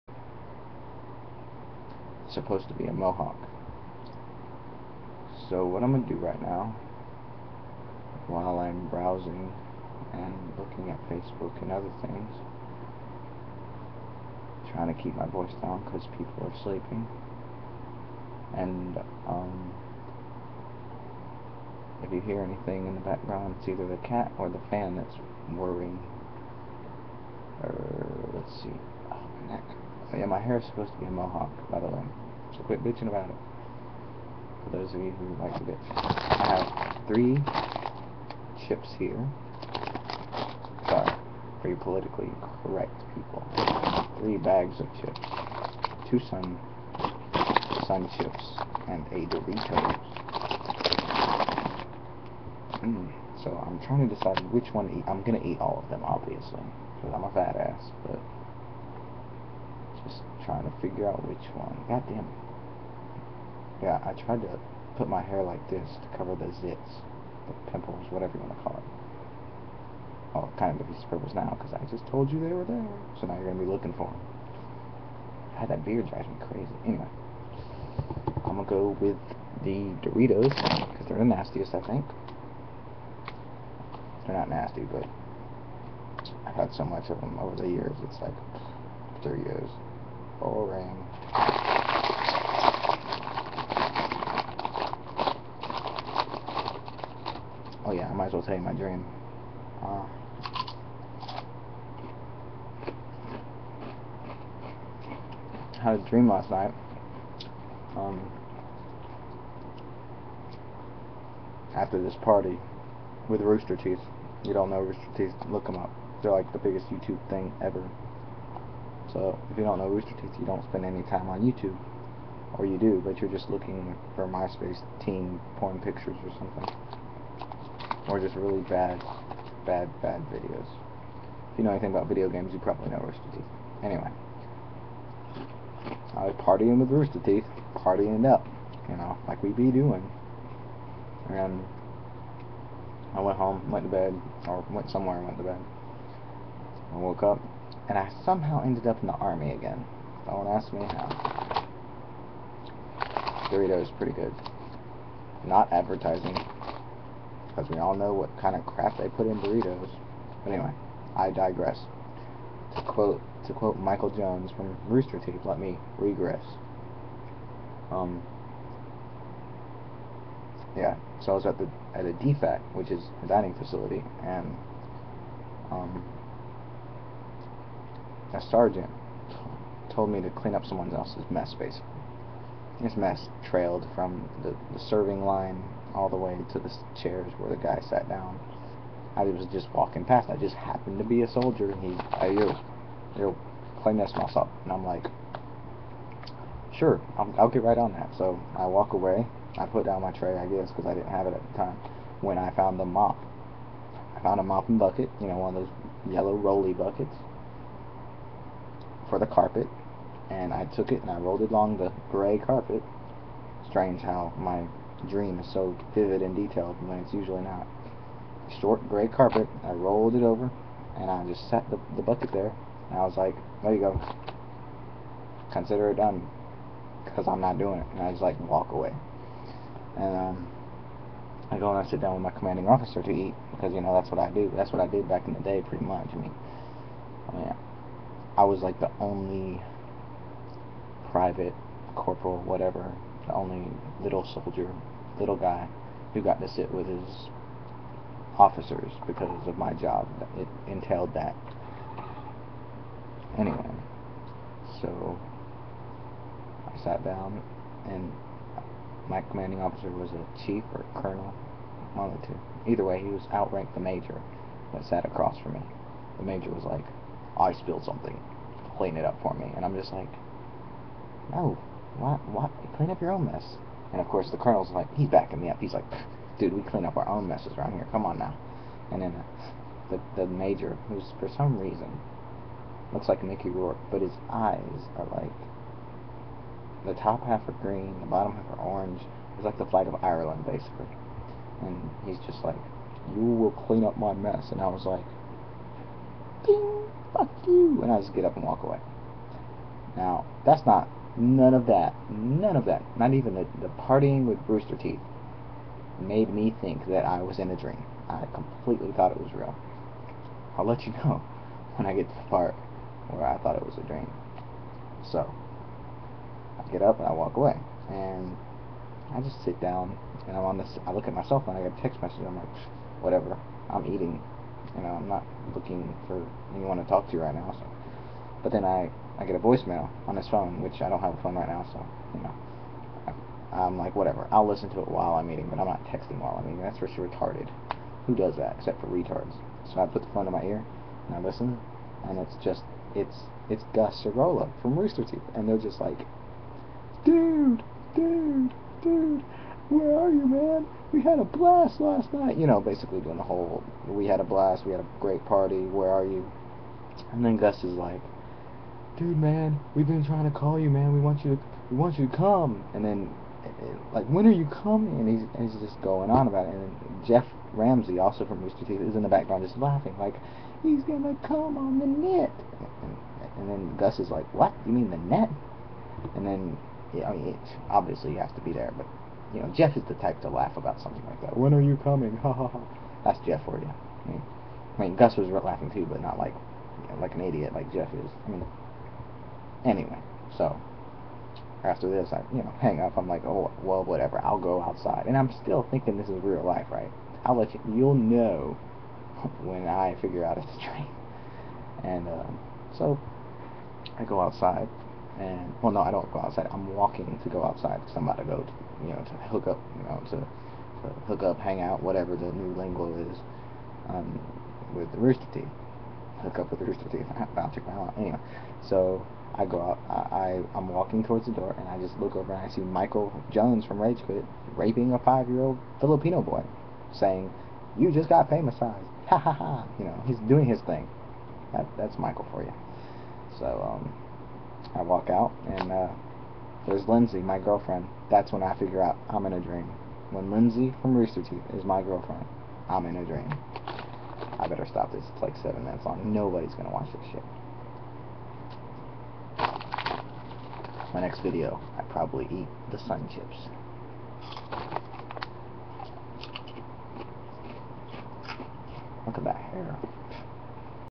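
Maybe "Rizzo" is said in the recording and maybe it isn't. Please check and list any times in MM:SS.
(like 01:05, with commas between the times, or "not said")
not said.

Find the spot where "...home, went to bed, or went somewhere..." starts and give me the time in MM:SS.
02:23.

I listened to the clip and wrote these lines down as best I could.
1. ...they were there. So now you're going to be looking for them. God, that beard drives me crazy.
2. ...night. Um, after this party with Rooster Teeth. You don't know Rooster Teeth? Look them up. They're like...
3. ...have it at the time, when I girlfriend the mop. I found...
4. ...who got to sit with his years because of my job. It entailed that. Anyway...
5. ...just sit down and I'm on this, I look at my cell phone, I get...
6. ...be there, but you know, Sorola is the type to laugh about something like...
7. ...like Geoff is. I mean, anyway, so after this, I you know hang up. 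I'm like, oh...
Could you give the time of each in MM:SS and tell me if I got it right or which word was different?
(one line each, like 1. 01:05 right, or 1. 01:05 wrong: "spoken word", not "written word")
1. 01:12 right
2. 01:46 right
3. 03:21 wrong: "found", not "girlfriend"
4. 04:06 wrong: "officers", not "years"
5. 05:19 right
6. 06:18 wrong: "Geoff", not "Sorola"
7. 06:27 right.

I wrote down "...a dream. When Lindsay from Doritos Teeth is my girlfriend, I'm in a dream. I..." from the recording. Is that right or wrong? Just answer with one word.
wrong.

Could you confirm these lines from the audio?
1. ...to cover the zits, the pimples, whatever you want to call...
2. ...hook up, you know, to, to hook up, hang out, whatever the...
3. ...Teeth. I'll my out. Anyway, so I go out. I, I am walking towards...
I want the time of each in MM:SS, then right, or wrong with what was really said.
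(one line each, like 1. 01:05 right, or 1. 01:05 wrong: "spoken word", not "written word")
1. 01:06 right
2. 06:49 right
3. 06:56 right.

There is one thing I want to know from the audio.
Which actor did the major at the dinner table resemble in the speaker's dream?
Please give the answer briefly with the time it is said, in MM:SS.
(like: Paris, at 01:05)
Mickey Rourke, at 04:43.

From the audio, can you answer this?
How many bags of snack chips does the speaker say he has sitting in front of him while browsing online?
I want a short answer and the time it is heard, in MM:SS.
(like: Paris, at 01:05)
3, at 00:44.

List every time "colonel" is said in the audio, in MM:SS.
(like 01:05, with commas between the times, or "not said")
04:21, 04:34.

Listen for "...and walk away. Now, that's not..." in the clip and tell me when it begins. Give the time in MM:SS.
04:58.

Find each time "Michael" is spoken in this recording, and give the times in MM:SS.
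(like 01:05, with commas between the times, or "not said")
02:43, 07:02, 07:11.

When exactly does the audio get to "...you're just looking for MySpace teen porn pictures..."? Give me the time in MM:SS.
02:03.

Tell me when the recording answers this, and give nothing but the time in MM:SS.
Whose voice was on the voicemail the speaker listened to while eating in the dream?
05:43.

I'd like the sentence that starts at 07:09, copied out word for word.
You know, he's doing his thing.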